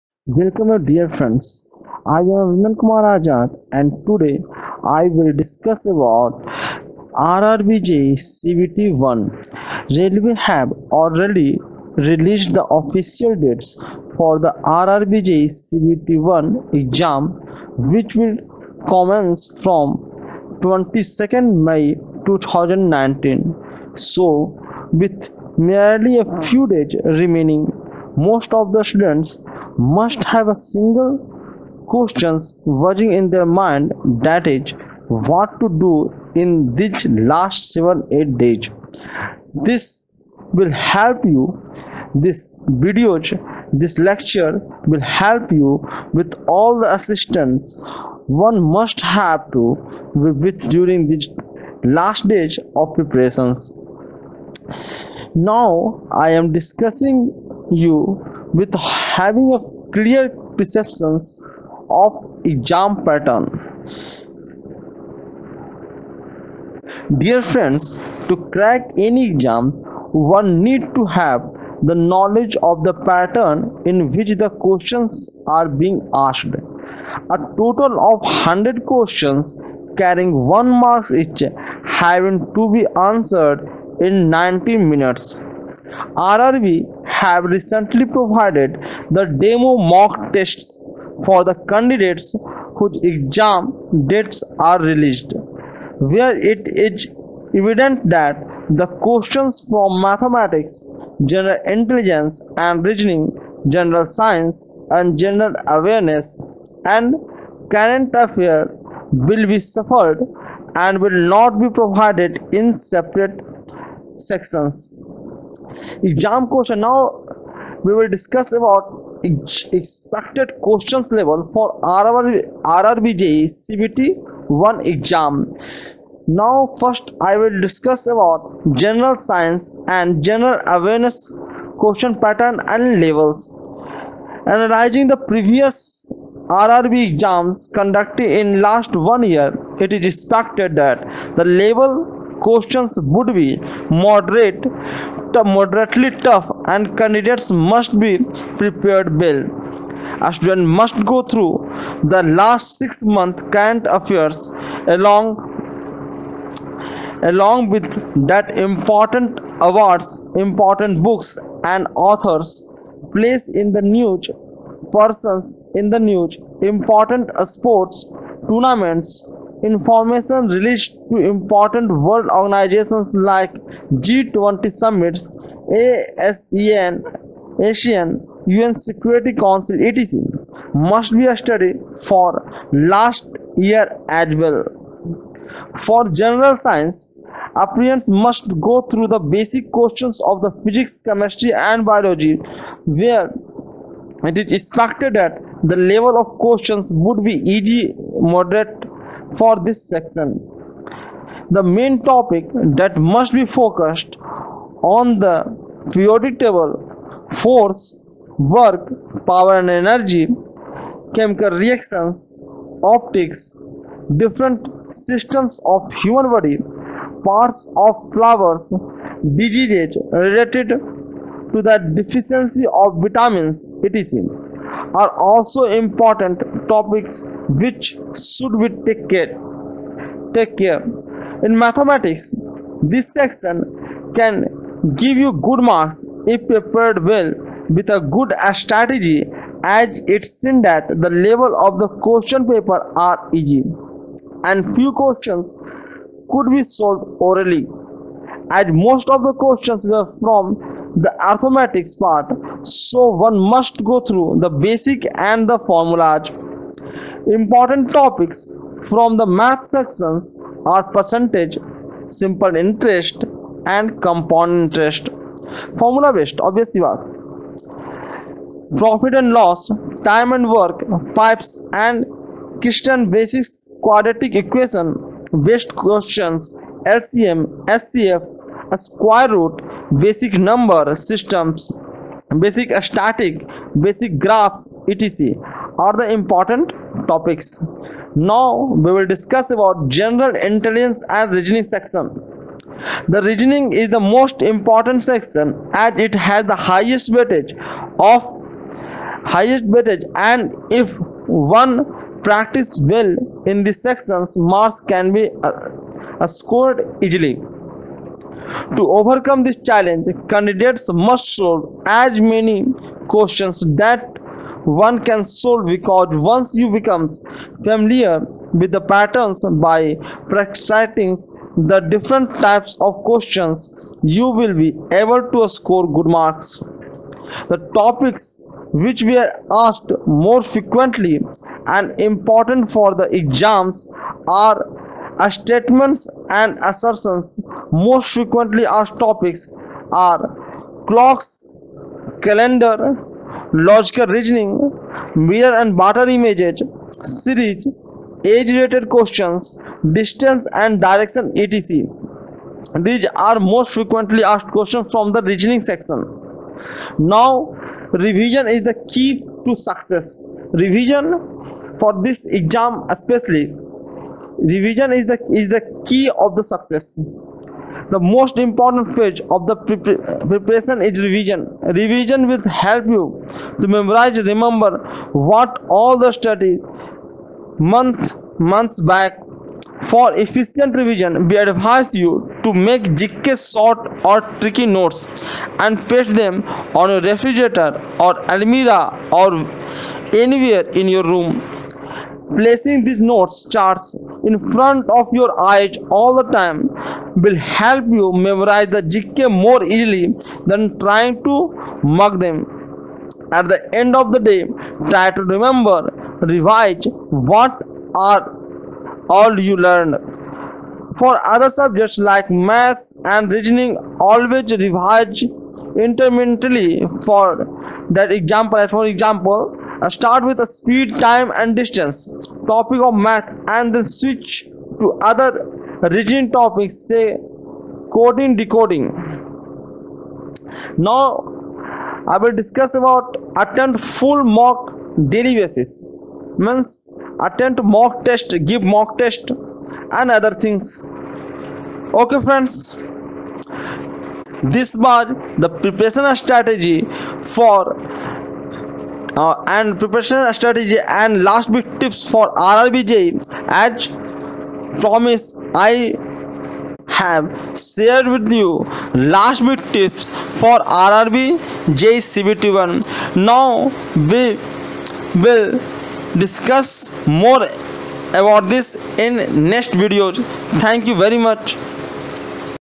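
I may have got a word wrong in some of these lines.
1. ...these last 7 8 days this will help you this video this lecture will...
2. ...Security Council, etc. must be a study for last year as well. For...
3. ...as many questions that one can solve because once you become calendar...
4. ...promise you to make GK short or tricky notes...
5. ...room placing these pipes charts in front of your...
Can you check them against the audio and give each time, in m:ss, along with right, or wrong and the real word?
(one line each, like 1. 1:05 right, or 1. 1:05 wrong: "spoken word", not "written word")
1. 0:36 right
2. 2:58 right
3. 5:11 wrong: "familiar", not "calendar"
4. 6:21 wrong: "advise", not "promise"
5. 6:31 wrong: "notes", not "pipes".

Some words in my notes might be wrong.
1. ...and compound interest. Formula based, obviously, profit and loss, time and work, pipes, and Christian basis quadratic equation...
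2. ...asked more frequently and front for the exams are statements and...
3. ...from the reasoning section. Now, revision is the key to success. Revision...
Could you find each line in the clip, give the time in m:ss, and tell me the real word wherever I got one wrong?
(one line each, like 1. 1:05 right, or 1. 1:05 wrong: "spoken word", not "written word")
1. 4:23 right
2. 5:29 wrong: "important", not "front"
3. 5:54 right.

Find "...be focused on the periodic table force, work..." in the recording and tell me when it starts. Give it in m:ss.
3:23.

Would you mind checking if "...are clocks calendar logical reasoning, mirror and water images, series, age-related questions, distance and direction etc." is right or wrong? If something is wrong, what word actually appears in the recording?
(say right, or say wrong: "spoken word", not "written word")
right.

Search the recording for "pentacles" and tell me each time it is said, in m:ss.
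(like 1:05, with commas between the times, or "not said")
not said.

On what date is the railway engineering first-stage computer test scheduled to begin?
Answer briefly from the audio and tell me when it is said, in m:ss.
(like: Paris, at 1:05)
22nd May 2019, at 0:20.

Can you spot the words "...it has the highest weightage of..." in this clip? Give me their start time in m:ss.
4:55.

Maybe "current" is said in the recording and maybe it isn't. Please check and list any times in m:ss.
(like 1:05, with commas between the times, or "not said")
1:47, 2:33.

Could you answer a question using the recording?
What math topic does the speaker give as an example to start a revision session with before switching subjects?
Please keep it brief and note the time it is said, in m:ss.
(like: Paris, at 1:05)
Speed, time and distance, at 7:00.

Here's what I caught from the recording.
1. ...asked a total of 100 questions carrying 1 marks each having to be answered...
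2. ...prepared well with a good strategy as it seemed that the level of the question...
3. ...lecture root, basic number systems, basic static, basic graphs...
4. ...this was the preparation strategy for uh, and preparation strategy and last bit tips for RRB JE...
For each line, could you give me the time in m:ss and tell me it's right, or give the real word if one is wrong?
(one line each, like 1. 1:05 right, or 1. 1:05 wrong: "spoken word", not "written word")
1. 1:16 right
2. 3:56 right
3. 4:38 wrong: "square", not "lecture"
4. 7:24 right.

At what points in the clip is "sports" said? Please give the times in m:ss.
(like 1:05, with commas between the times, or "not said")
2:47.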